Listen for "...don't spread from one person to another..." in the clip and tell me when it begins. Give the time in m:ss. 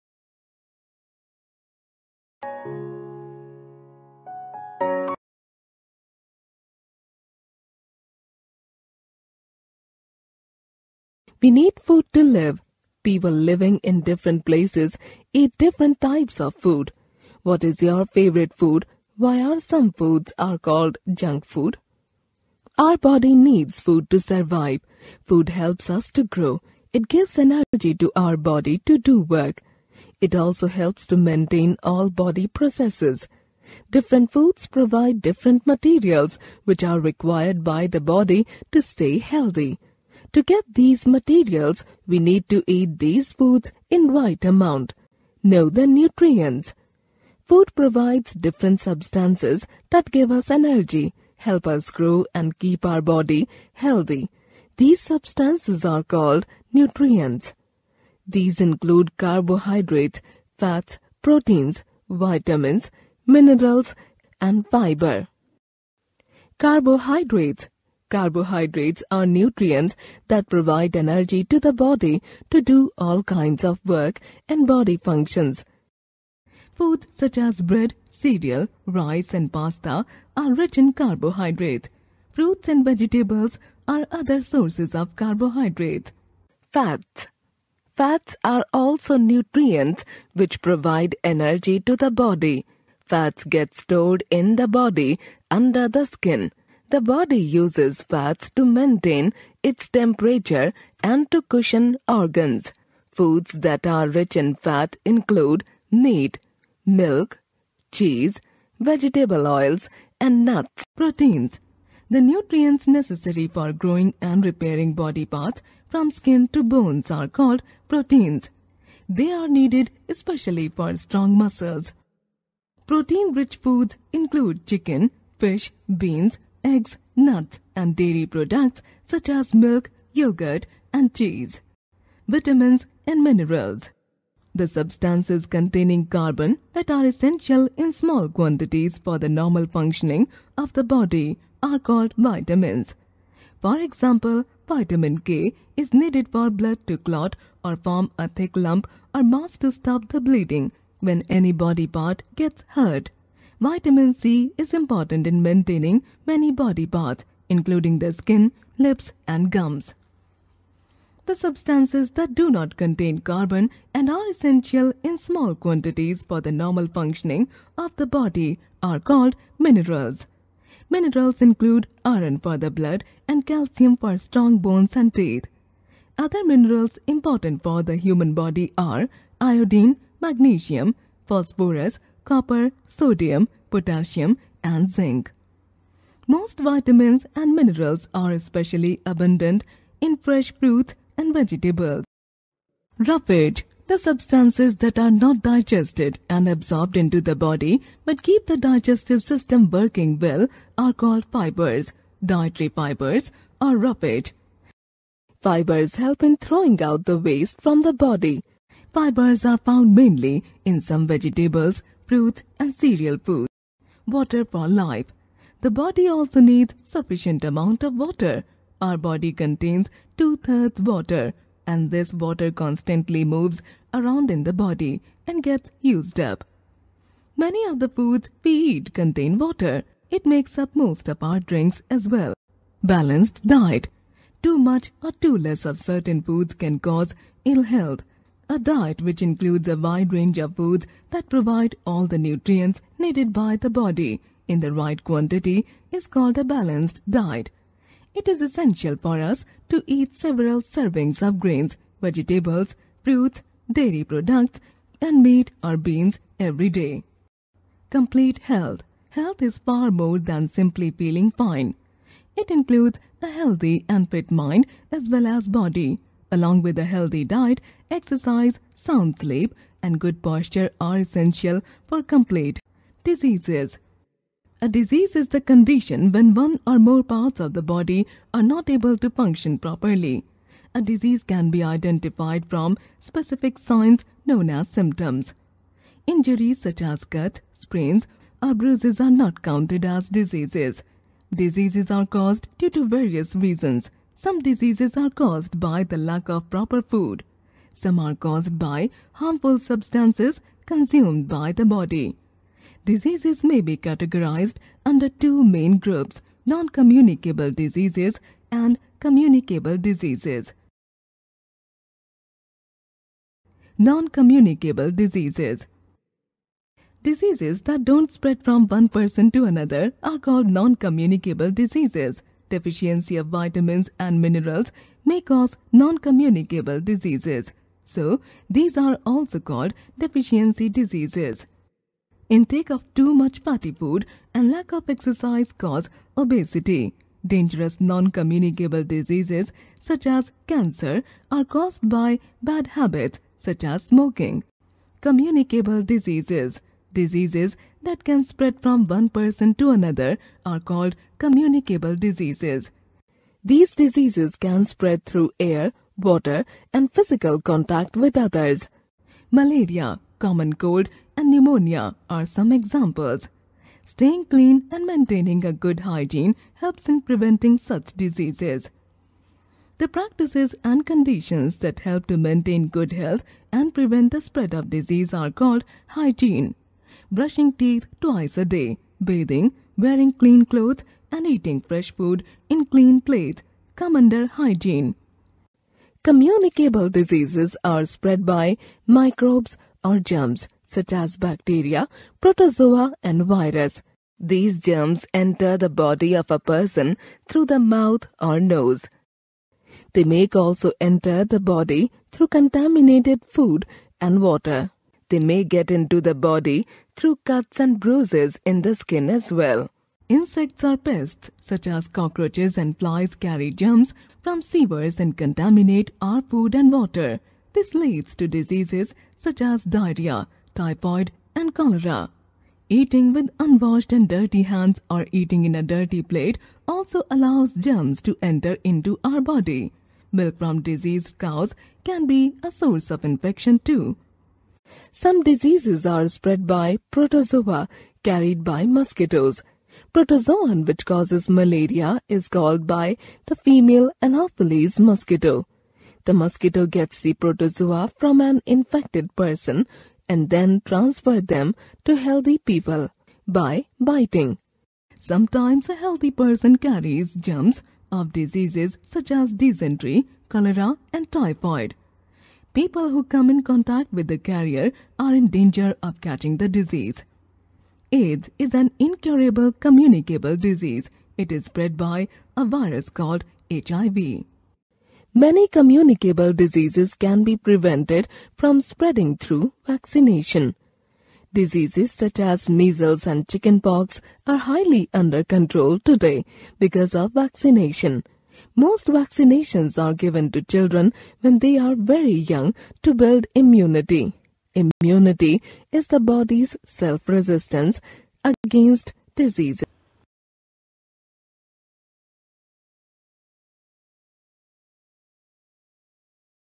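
5:17.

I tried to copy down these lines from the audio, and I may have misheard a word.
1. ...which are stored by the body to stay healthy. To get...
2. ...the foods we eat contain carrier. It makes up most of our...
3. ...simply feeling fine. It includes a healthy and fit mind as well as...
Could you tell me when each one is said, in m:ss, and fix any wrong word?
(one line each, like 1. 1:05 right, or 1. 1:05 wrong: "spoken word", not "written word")
1. 0:36 wrong: "required", not "stored"
2. 3:47 wrong: "water", not "carrier"
3. 4:20 right.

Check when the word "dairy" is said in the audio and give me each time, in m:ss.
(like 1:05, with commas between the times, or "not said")
2:07, 4:13.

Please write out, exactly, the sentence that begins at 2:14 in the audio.
The substances containing carbon that are essential in small quantities for the normal functioning of the body are called vitamins.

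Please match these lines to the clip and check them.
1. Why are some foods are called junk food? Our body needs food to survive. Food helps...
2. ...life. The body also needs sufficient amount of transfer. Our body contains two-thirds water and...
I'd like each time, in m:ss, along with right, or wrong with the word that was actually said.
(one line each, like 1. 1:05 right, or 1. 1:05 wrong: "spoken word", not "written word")
1. 0:19 right
2. 3:34 wrong: "water", not "transfer".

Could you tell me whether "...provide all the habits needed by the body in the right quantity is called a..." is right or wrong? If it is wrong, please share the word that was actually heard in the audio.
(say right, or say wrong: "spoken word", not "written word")
wrong: "nutrients", not "habits".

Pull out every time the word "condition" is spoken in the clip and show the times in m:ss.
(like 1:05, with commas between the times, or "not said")
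4:35, 6:10.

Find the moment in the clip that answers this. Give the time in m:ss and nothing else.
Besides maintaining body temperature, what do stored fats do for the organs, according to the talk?
1:41.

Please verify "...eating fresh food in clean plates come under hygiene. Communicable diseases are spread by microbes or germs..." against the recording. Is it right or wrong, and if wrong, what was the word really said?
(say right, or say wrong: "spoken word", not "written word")
right.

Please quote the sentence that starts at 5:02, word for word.
Diseases may be categorized under two main groups non communicable diseases and communicable diseases.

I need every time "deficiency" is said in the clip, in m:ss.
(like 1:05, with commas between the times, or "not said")
5:22, 5:29.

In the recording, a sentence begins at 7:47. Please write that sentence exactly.
AIDS is an incurable communicable disease.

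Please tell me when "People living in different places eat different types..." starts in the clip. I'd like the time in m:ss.
0:13.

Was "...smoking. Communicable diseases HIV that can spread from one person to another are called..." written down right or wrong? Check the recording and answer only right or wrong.
wrong.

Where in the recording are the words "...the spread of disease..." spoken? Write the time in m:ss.
6:14.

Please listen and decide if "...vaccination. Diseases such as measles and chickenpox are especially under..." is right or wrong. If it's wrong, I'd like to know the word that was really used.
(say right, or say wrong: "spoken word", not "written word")
wrong: "highly", not "especially".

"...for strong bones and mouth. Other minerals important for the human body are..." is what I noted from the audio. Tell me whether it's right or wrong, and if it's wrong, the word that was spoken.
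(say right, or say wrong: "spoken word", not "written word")
wrong: "teeth", not "mouth".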